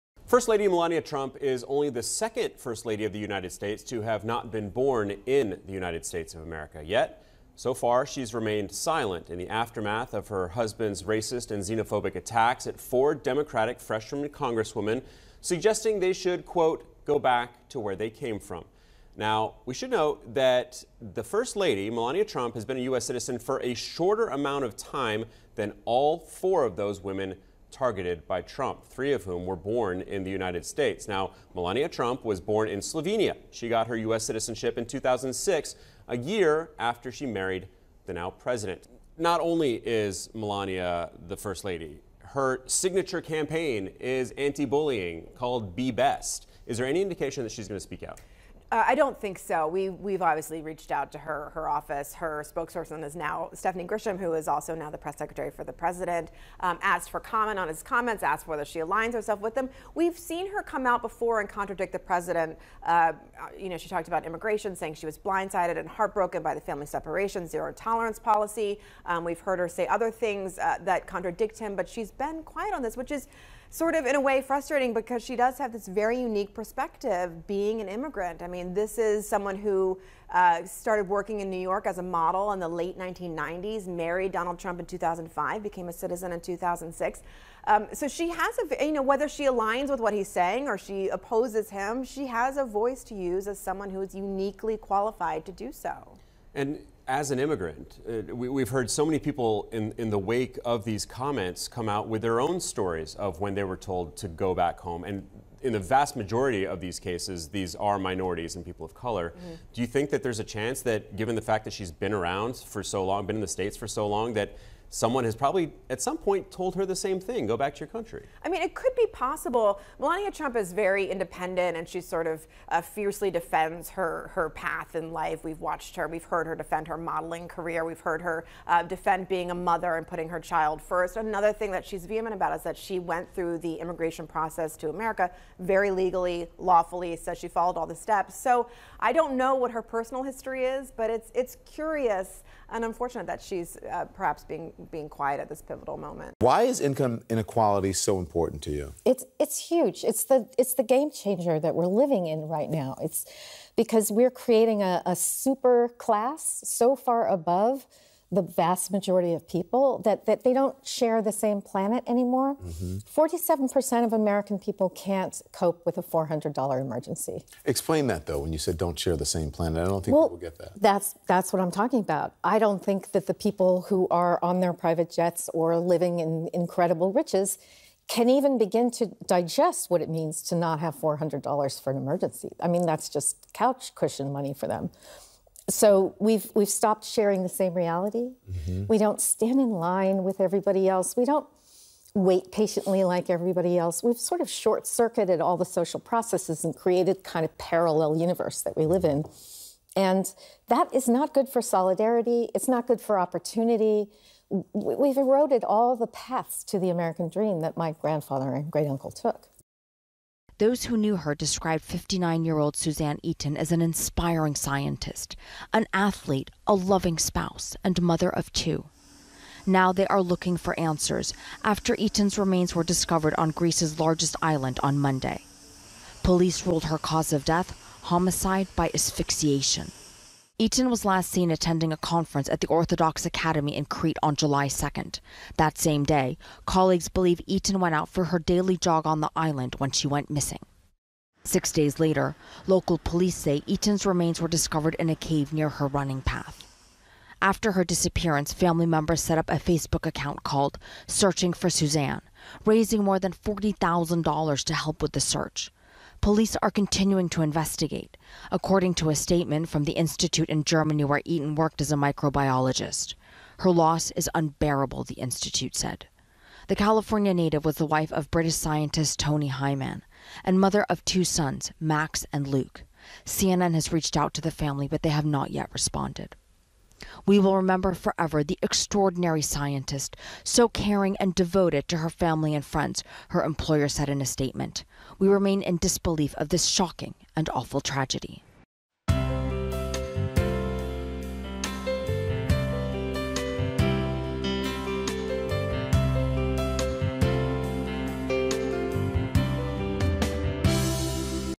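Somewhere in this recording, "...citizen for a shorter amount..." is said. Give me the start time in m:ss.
0:23.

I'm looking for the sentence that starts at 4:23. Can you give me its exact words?
Her loss is unbearable, the institute said.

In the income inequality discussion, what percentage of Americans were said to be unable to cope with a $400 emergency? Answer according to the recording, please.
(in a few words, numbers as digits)
47%.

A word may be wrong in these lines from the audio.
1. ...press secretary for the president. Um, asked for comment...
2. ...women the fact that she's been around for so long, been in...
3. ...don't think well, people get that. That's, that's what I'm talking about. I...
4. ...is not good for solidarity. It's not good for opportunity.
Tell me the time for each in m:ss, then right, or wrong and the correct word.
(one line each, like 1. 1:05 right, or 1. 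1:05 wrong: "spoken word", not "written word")
1. 0:54 right
2. 1:51 wrong: "given", not "women"
3. 2:49 right
4. 3:20 right.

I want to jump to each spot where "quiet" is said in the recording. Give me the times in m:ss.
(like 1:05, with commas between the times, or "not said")
1:12, 2:25.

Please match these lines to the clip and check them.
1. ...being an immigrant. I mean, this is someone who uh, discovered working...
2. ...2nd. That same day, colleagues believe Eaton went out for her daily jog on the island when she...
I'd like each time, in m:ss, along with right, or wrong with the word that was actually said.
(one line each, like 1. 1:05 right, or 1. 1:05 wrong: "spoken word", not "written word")
1. 1:17 wrong: "started", not "discovered"
2. 3:54 right.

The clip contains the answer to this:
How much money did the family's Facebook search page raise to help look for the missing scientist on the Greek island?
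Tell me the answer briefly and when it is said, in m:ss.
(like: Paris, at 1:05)
$40,000, at 4:13.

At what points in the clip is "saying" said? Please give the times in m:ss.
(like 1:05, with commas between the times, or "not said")
1:04, 1:30.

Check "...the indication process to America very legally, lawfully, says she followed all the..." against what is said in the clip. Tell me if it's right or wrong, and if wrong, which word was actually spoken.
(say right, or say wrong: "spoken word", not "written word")
wrong: "immigration", not "indication".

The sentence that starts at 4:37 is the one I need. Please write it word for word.
We will remember forever the extraordinary scientist, so caring and devoted to her family and friends, her employer said in a statement.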